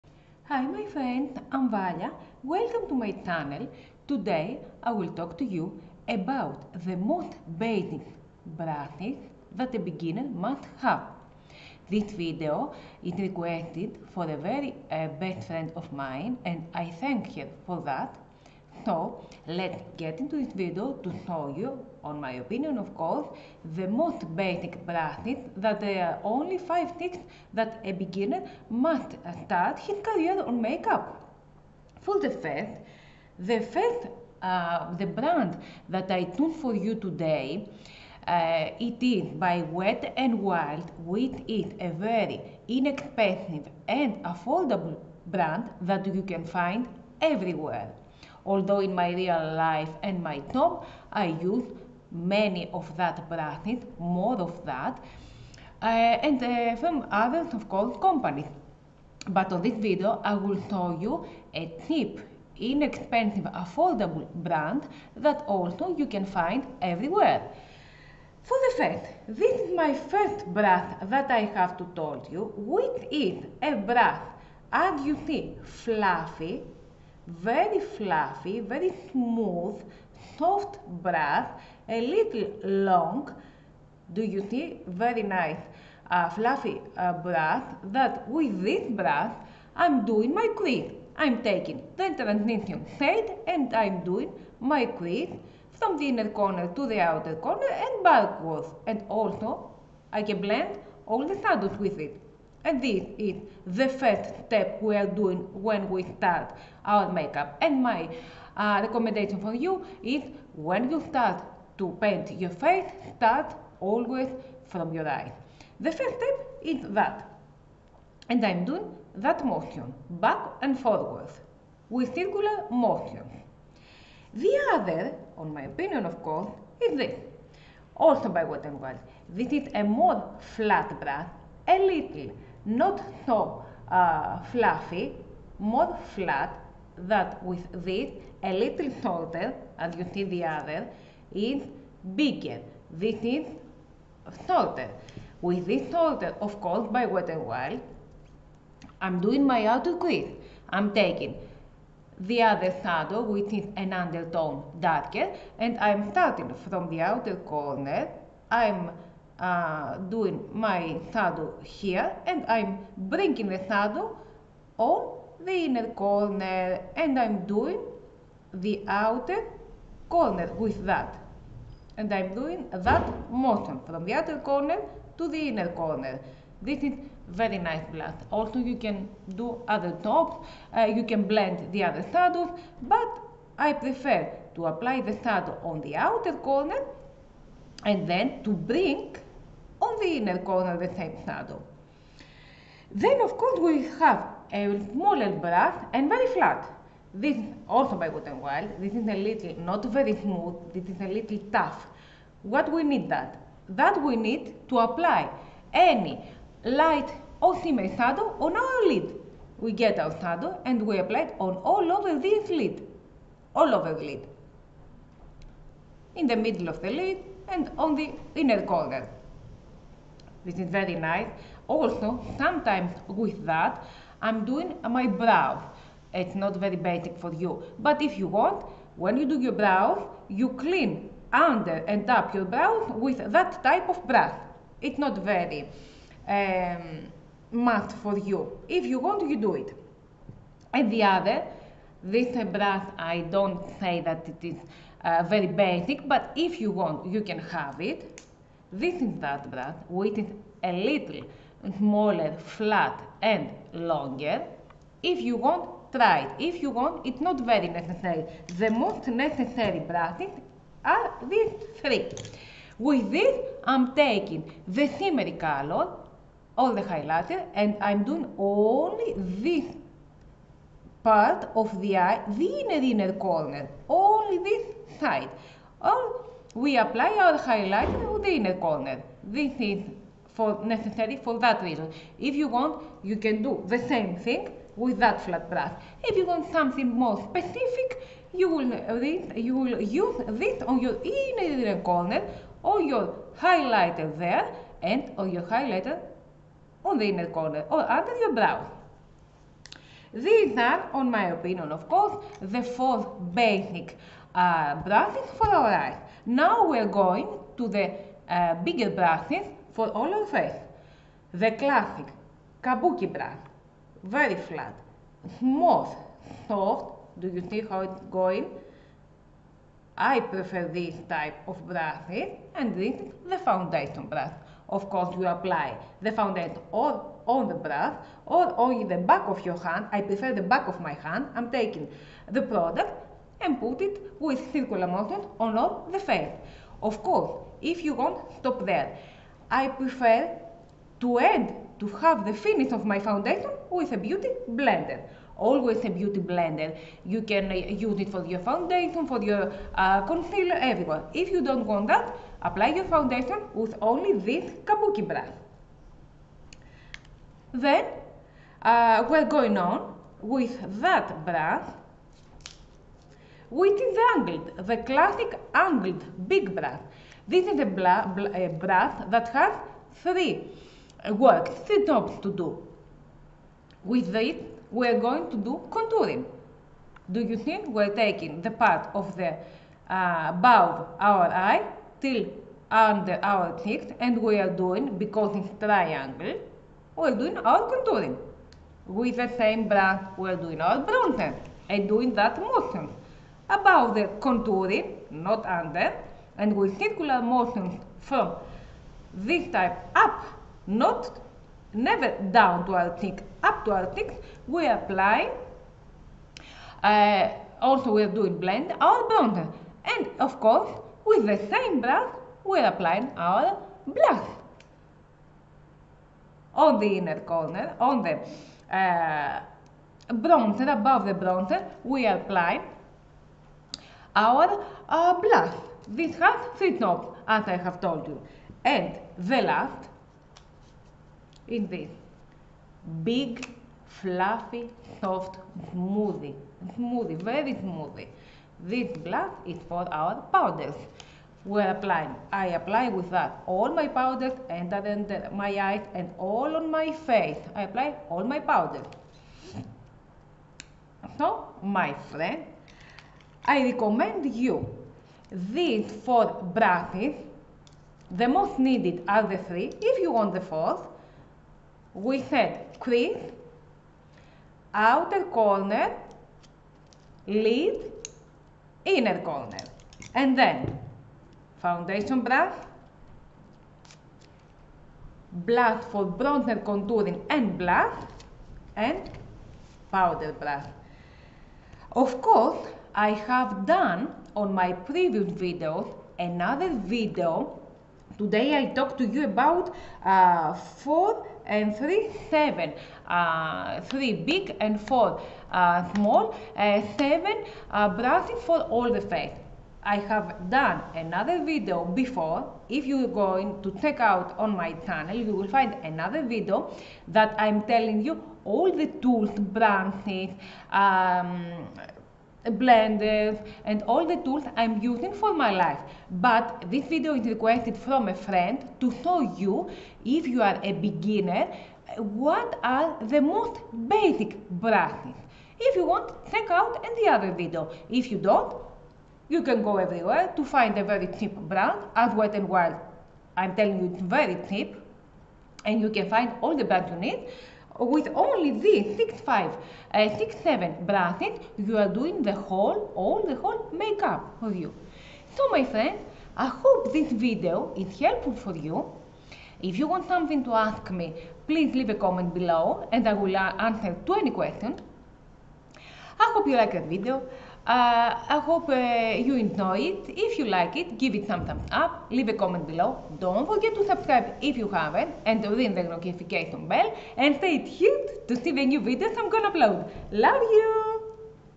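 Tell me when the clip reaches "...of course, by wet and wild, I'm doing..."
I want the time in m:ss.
2:26.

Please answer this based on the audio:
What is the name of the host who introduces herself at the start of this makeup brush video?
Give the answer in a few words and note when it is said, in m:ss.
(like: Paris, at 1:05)
Valya, at 0:01.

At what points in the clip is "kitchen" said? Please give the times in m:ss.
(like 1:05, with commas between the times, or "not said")
not said.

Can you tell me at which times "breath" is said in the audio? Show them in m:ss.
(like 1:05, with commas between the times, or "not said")
1:21, 1:28.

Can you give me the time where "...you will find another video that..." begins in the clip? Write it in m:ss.
8:25.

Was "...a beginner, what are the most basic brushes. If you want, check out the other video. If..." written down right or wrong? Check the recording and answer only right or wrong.
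right.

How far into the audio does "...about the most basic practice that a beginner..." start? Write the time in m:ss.
0:06.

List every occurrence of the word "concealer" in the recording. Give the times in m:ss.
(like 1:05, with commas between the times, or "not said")
5:50.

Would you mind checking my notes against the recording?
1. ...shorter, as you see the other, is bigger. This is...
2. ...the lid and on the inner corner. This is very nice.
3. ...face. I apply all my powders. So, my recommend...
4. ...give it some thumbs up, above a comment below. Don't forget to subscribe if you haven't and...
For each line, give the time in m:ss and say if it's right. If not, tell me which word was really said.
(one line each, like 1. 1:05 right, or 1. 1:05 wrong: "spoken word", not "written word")
1. 2:19 right
2. 3:36 right
3. 7:26 wrong: "friend", not "recommend"
4. 9:20 wrong: "leave", not "above".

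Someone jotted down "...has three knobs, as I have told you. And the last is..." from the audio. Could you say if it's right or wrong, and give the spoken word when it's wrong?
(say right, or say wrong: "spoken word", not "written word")
right.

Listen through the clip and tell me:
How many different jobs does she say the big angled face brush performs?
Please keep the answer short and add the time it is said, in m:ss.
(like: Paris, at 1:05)
3, at 6:11.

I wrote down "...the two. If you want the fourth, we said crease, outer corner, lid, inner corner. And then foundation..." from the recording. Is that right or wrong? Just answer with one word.
wrong.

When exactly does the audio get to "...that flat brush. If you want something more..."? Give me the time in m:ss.
4:44.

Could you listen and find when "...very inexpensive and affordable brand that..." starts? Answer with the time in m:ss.
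0:41.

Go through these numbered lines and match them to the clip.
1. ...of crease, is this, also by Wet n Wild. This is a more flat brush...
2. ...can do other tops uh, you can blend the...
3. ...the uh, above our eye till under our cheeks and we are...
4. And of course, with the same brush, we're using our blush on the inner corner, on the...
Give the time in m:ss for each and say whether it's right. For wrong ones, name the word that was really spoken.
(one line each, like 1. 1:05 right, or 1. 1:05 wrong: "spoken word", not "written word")
1. 2:06 wrong: "course", not "crease"
2. 2:58 right
3. 6:19 right
4. 6:49 wrong: "applying", not "using".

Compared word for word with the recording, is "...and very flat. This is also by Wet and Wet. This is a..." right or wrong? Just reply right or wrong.
wrong.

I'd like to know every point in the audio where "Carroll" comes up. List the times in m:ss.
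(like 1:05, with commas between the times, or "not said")
not said.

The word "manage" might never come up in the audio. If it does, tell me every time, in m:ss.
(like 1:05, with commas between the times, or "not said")
not said.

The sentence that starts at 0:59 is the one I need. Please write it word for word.
But on this video I will show you a cheap, inexpensive, affordable brand that also you can find everywhere.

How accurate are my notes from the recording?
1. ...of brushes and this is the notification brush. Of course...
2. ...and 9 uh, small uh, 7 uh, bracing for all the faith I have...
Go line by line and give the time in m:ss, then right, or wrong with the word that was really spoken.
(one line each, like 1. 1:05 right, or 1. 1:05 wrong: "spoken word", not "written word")
1. 5:21 wrong: "foundation", not "notification"
2. 8:14 wrong: "4", not "9".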